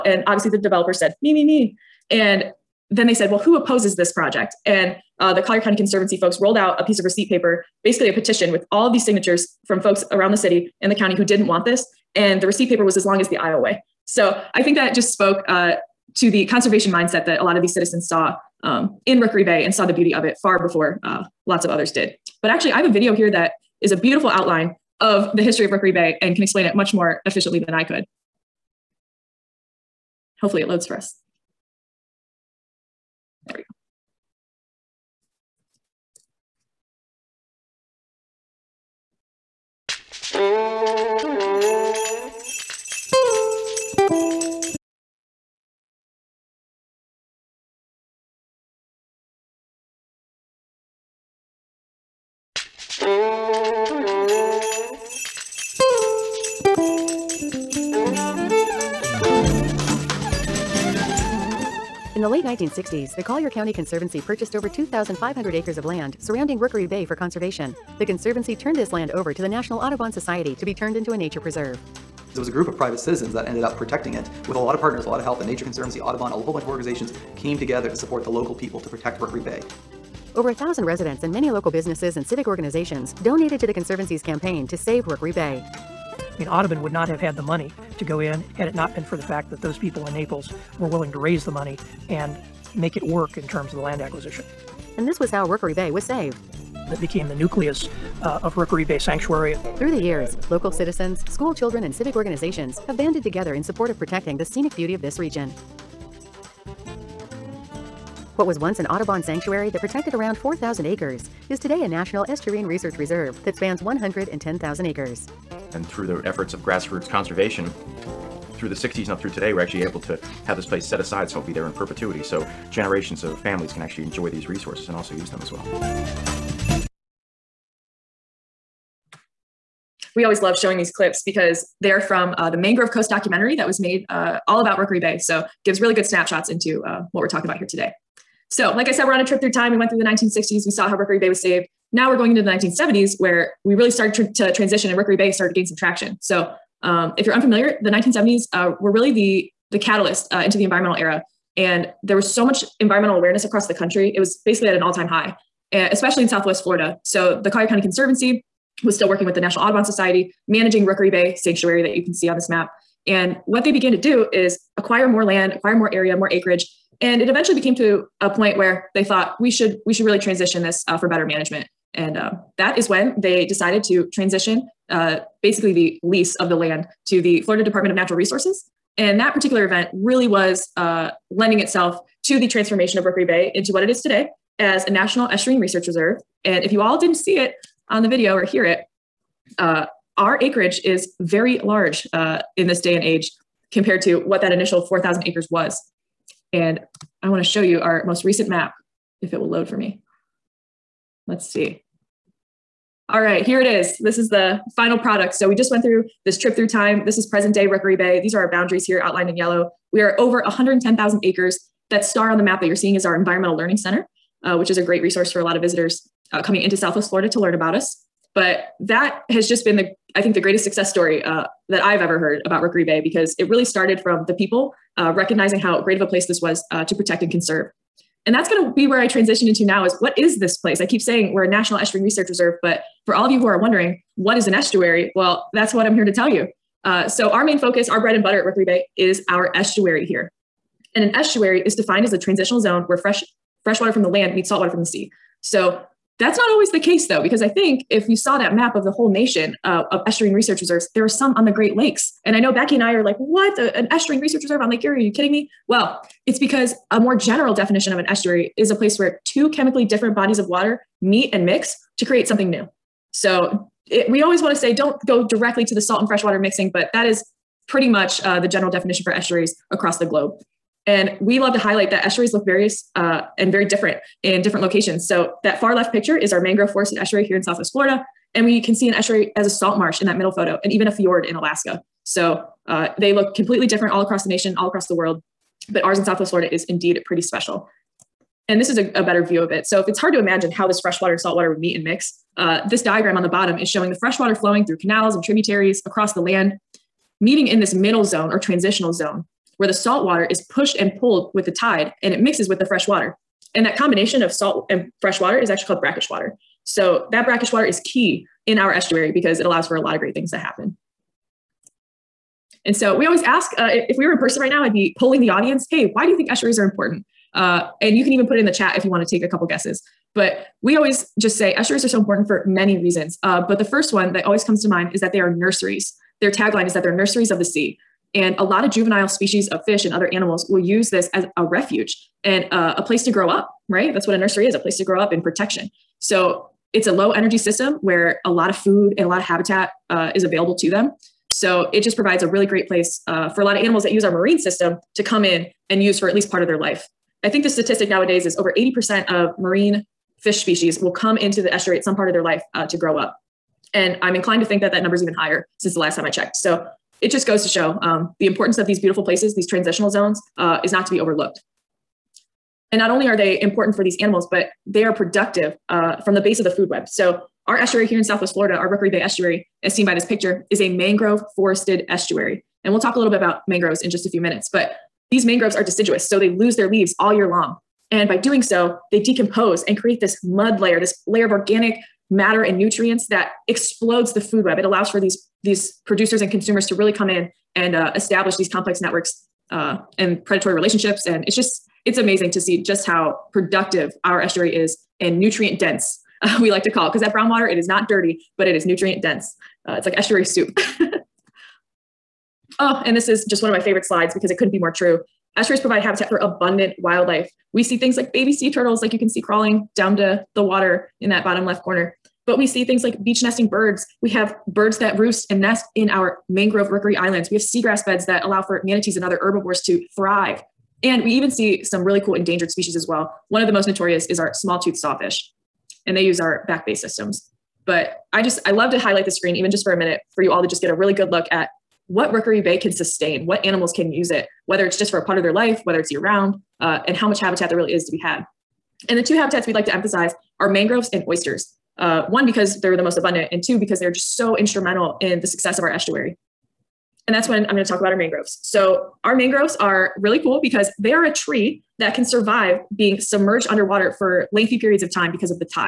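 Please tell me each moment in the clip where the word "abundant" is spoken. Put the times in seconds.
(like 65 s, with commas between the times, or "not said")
406 s, 442 s.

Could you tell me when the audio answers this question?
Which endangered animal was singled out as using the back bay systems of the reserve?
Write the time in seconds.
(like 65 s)
424 s.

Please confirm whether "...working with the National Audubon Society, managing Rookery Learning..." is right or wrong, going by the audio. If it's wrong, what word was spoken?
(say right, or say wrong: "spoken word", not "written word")
wrong: "Bay", not "Learning".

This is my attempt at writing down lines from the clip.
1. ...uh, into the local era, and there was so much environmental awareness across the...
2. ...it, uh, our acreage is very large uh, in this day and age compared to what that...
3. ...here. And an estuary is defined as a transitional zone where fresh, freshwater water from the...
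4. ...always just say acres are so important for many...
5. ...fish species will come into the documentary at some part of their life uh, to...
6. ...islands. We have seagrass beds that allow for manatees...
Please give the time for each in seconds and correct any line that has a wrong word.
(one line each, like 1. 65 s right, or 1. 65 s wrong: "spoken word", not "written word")
1. 150 s wrong: "environmental", not "local"
2. 188 s right
3. 240 s right
4. 320 s wrong: "estuaries", not "acres"
5. 350 s wrong: "estuary", not "documentary"
6. 416 s right.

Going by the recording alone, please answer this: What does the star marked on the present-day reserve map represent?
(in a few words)
Environmental Learning Center.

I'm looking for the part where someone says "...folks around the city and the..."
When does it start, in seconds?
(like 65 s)
9 s.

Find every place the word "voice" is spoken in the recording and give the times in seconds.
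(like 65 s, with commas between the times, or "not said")
not said.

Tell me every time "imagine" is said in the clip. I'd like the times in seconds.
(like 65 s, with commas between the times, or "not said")
290 s.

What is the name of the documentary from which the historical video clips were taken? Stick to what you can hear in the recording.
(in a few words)
Mangrove Coast.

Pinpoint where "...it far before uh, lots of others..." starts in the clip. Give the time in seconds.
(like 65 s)
20 s.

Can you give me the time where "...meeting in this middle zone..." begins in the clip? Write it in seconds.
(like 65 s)
297 s.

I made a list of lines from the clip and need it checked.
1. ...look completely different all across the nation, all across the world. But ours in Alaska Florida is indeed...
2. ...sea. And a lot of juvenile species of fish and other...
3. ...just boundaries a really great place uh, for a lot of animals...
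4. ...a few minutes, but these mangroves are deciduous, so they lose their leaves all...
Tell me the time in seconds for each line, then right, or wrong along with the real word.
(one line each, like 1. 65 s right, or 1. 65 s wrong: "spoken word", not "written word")
1. 283 s wrong: "Southwest", not "Alaska"
2. 327 s right
3. 341 s wrong: "provides", not "boundaries"
4. 374 s right.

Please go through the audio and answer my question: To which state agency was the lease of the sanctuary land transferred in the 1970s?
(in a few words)
Florida Department of Natural Resources.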